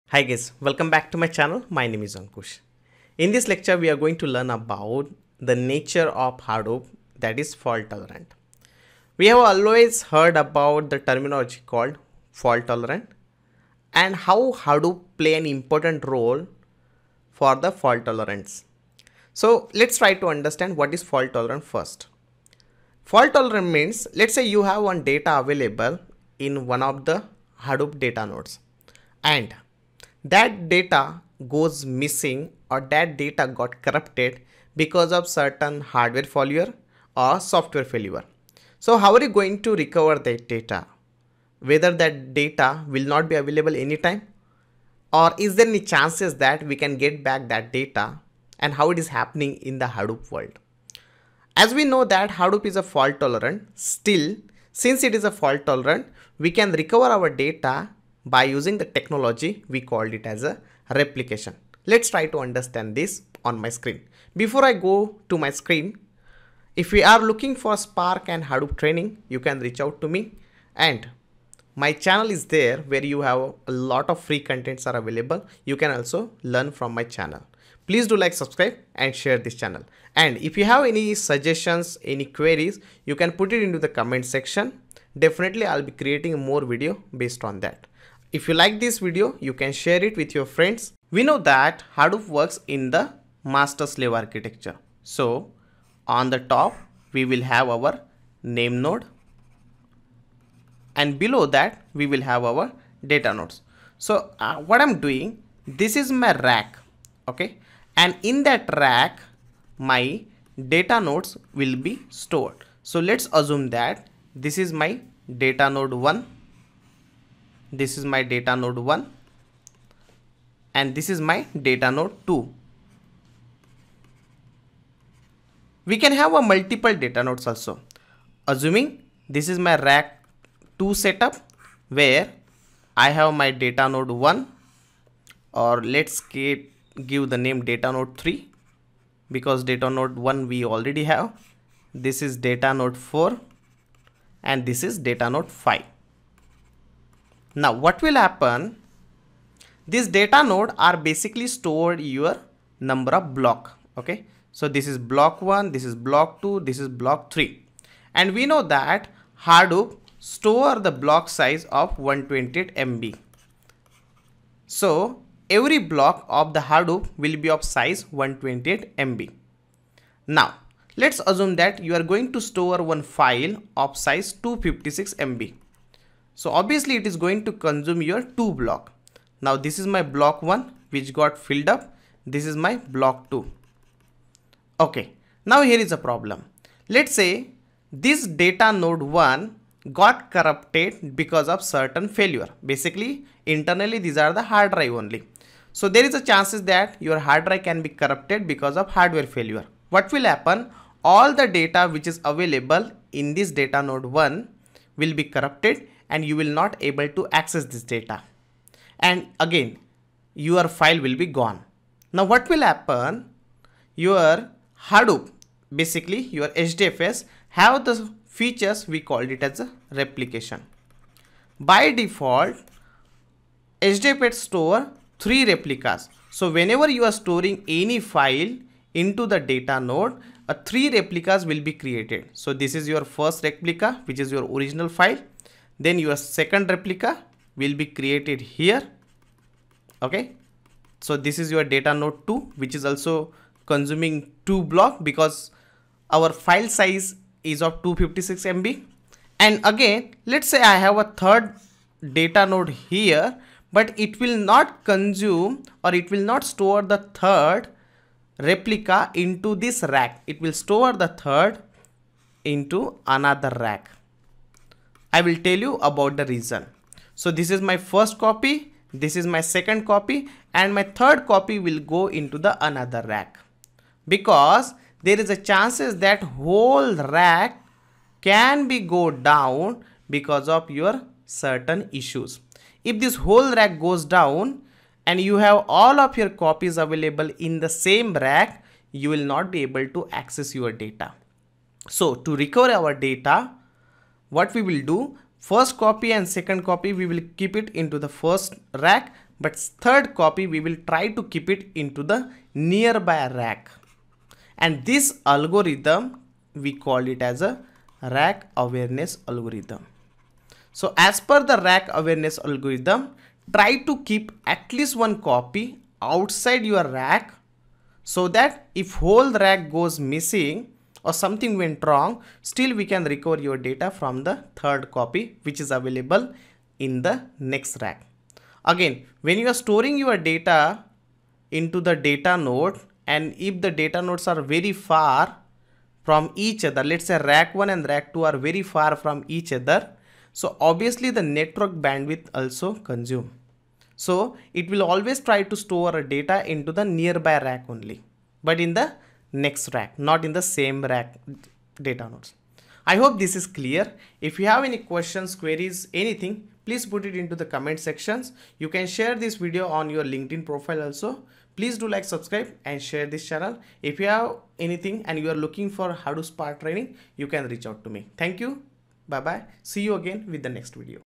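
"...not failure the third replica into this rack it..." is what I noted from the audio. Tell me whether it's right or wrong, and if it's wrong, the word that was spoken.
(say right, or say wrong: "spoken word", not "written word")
wrong: "store", not "failure".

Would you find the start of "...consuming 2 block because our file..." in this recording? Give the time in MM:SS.
04:03.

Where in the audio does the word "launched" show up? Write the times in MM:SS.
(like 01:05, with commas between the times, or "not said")
not said.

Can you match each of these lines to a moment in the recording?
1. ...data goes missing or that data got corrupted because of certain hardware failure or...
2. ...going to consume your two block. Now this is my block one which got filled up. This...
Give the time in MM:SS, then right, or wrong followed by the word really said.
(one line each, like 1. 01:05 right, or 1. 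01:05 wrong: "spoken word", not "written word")
1. 00:30 right
2. 02:57 right.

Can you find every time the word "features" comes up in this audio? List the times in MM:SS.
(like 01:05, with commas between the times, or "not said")
03:38.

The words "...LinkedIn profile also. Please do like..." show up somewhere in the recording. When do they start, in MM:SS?
06:00.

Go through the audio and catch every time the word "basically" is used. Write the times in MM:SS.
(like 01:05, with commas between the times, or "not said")
02:30, 03:12, 03:35.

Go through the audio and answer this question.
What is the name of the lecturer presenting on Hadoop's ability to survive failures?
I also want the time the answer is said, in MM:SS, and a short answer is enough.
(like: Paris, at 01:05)
Ankush, at 00:02.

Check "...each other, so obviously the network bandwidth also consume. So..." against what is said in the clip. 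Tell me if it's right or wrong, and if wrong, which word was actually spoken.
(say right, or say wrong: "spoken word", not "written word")
right.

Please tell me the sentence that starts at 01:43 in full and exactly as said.
So uh, what I'm doing, this is my rack, okay?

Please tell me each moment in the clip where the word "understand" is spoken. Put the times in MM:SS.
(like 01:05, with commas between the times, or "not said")
00:20, 01:02.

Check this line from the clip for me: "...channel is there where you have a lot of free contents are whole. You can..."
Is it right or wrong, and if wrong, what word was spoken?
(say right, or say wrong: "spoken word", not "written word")
wrong: "available", not "whole".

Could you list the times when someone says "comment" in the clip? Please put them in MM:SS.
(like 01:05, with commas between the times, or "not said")
01:23, 05:57.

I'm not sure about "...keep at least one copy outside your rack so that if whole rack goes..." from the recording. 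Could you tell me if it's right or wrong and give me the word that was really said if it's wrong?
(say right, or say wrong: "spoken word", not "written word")
right.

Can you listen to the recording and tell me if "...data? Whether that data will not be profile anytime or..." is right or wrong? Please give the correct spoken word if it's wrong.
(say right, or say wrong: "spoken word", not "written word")
wrong: "available", not "profile".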